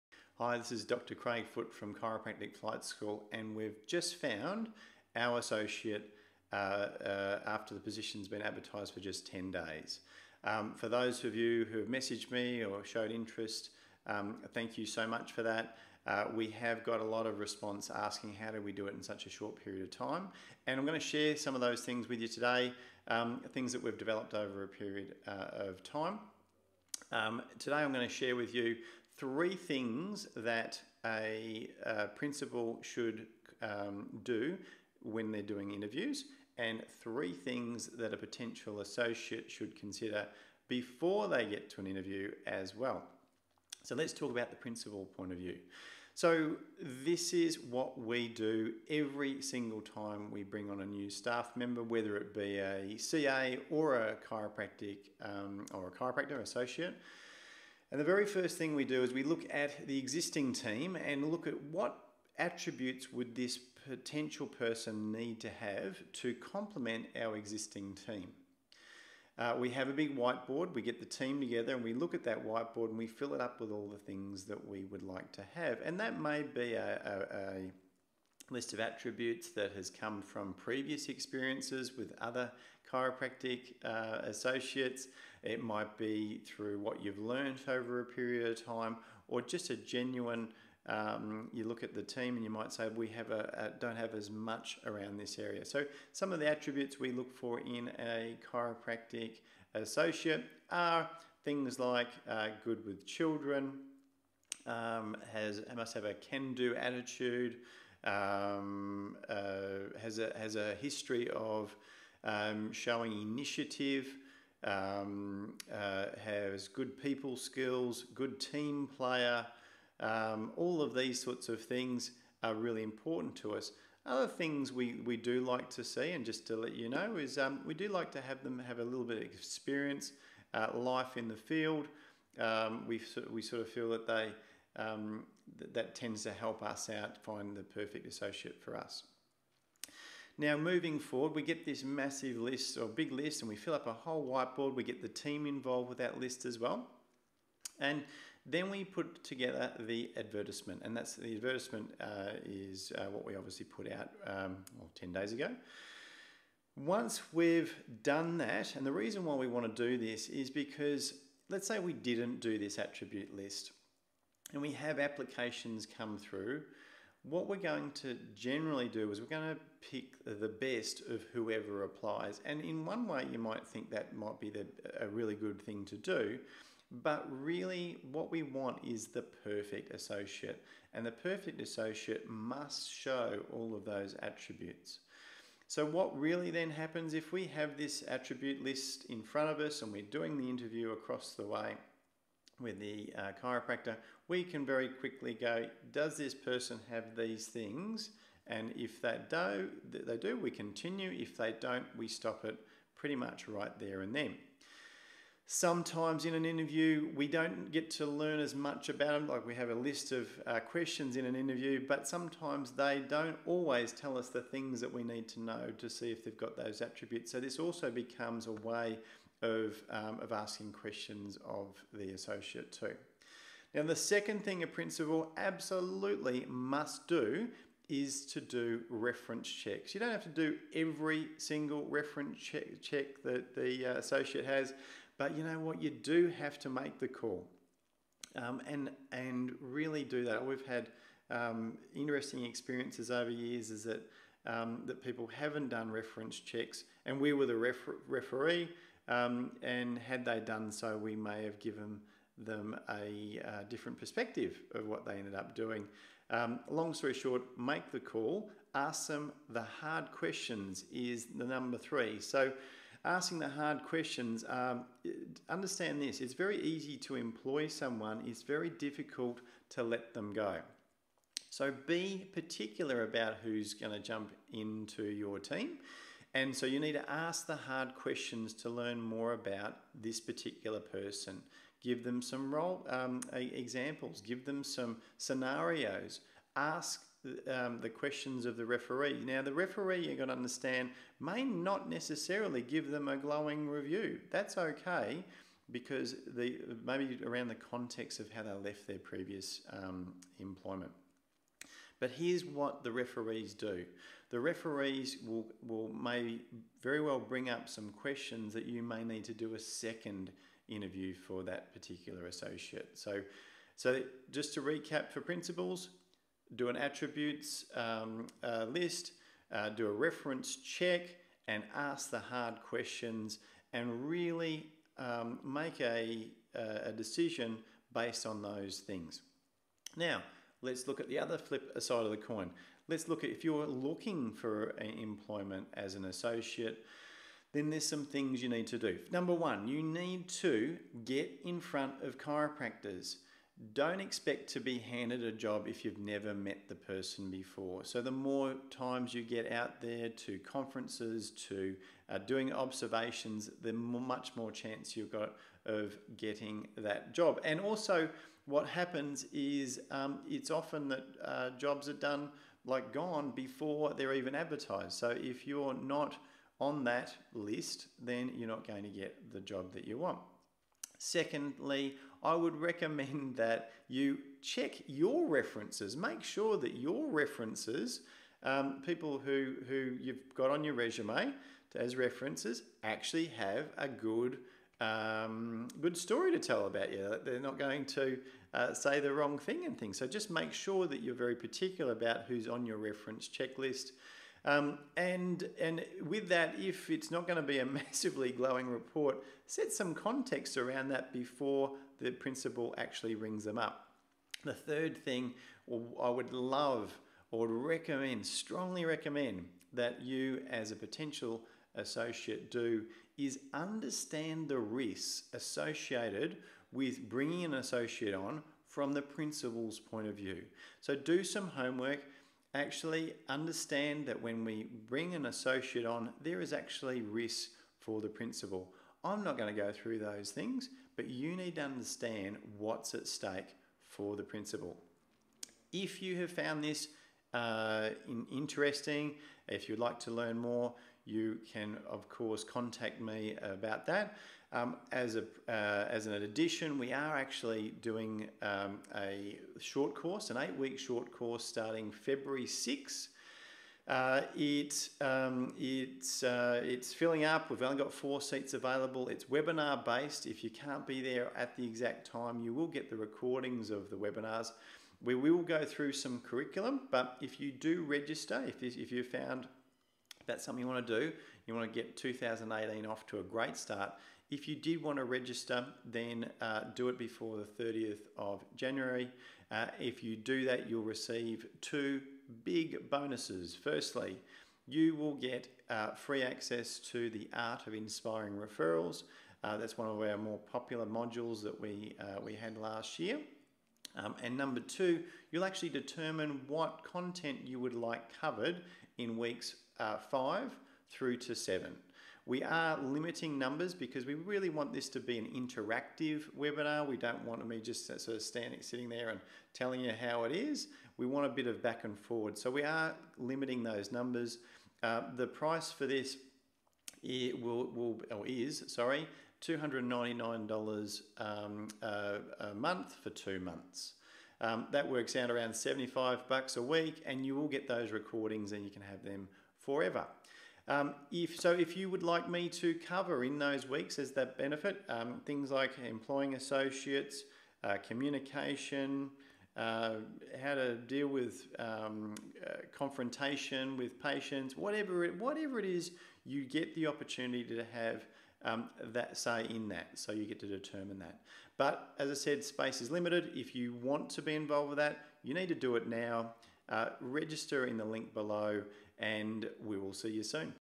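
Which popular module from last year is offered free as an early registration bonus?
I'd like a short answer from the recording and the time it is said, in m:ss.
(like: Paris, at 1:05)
The Art of Inspiring Referrals, at 8:07.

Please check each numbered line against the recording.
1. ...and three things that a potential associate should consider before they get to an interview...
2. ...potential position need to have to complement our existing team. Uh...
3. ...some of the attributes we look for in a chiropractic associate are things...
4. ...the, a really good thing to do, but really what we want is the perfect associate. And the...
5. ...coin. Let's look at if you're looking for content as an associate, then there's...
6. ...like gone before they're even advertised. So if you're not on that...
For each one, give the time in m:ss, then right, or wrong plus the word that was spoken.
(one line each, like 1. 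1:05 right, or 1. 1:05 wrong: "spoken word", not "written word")
1. 0:36 right
2. 1:03 wrong: "person", not "position"
3. 1:36 right
4. 2:54 right
5. 5:32 wrong: "employment", not "content"
6. 6:02 right.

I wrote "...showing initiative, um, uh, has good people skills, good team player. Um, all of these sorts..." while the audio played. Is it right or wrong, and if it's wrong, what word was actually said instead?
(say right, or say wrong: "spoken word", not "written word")
right.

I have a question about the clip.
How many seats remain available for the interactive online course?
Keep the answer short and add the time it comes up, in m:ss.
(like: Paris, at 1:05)
4, at 7:37.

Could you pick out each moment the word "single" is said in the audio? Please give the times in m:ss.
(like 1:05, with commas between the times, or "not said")
0:49, 3:51.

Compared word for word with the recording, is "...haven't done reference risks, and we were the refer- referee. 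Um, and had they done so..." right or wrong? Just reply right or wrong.
wrong.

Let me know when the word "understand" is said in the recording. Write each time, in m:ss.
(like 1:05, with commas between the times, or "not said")
4:25, 4:50, 6:53, 7:03, 7:11.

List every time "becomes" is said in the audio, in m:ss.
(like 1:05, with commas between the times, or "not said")
3:37.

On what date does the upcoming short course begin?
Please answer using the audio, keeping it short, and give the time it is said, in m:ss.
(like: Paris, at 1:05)
February 6th, at 7:31.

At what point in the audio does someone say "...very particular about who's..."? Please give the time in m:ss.
6:31.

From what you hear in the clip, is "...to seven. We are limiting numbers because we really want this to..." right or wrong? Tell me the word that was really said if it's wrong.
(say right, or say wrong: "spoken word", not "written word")
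right.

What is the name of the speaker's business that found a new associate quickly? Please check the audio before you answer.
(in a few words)
Chiropractic Flight School.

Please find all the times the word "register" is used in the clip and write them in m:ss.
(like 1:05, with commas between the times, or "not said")
7:47, 7:55, 9:17.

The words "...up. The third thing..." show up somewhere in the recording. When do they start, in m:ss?
6:43.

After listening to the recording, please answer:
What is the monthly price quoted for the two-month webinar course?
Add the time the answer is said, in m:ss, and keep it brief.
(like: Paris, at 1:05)
$299, at 8:39.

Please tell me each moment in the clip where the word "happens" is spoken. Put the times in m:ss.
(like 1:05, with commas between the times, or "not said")
3:06, 5:58.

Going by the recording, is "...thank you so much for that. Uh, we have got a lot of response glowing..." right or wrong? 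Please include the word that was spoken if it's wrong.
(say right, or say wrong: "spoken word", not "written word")
wrong: "asking", not "glowing".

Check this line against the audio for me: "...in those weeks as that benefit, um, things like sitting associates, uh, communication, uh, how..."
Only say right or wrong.
wrong.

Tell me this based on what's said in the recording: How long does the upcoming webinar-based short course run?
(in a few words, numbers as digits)
8 weeks.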